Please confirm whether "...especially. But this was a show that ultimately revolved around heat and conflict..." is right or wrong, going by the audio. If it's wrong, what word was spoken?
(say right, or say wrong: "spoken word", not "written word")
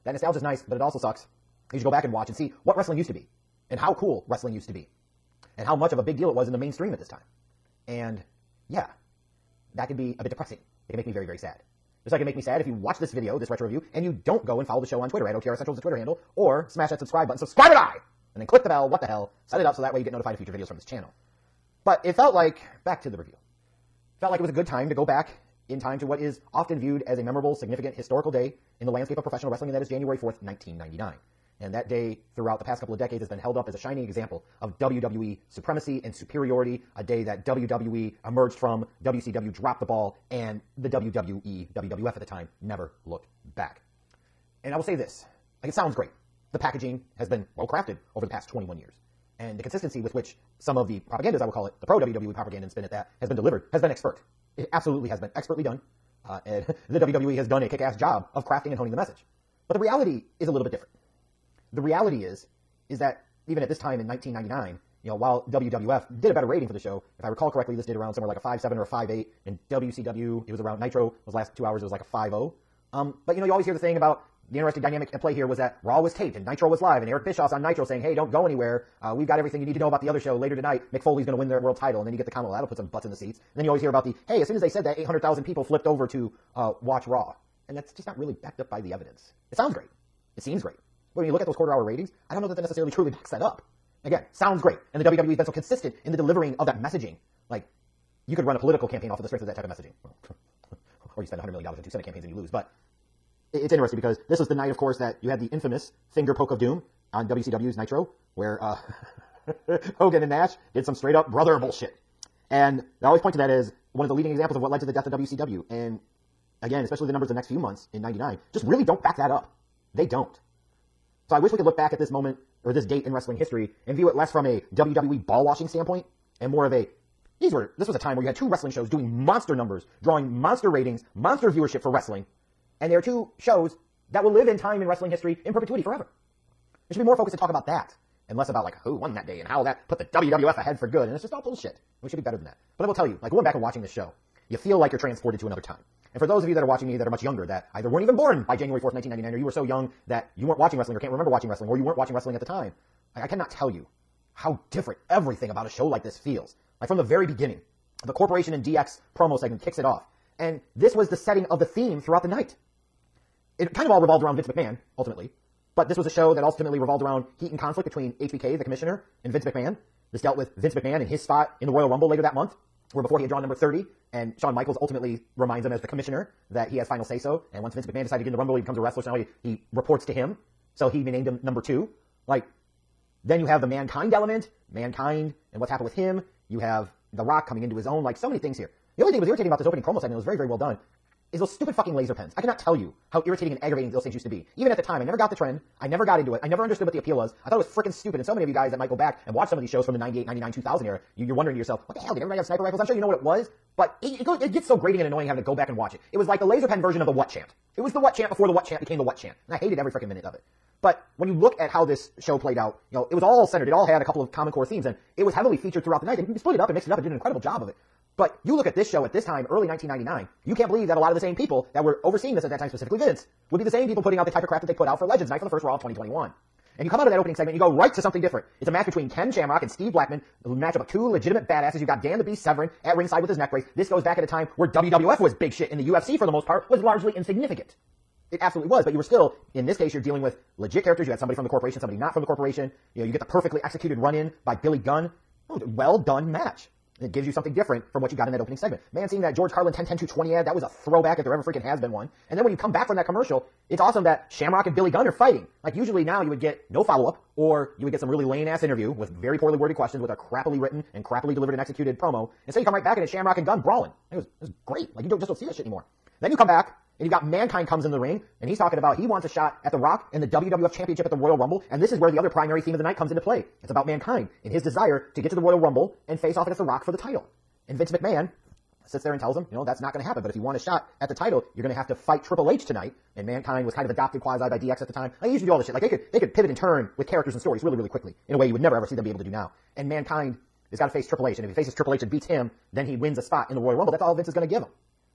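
wrong: "ultimately", not "especially".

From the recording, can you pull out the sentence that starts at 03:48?
It's a match between Ken Shamrock and Steve Blackman matchup of two legitimate badasses.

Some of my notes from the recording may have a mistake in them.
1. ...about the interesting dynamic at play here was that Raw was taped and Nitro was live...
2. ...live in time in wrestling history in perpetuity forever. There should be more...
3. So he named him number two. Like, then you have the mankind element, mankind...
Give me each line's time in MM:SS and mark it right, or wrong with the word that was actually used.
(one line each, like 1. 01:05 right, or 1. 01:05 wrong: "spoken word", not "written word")
1. 01:13 right
2. 02:14 right
3. 03:00 right.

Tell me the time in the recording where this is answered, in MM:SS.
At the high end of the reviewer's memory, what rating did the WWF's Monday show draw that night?
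01:08.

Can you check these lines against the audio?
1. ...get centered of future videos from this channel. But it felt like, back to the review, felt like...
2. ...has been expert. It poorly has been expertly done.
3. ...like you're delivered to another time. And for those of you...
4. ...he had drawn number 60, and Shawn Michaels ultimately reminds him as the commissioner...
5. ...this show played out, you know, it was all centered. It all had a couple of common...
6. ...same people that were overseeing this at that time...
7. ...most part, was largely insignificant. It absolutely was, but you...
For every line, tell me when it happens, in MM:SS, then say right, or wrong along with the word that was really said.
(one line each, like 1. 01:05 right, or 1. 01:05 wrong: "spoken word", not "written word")
1. 00:20 wrong: "notified", not "centered"
2. 00:53 wrong: "absolutely", not "poorly"
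3. 02:24 wrong: "transported", not "delivered"
4. 02:53 wrong: "30", not "60"
5. 03:31 right
6. 03:41 right
7. 03:56 right.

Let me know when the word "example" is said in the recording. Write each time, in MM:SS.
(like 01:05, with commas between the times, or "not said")
00:34, 01:54.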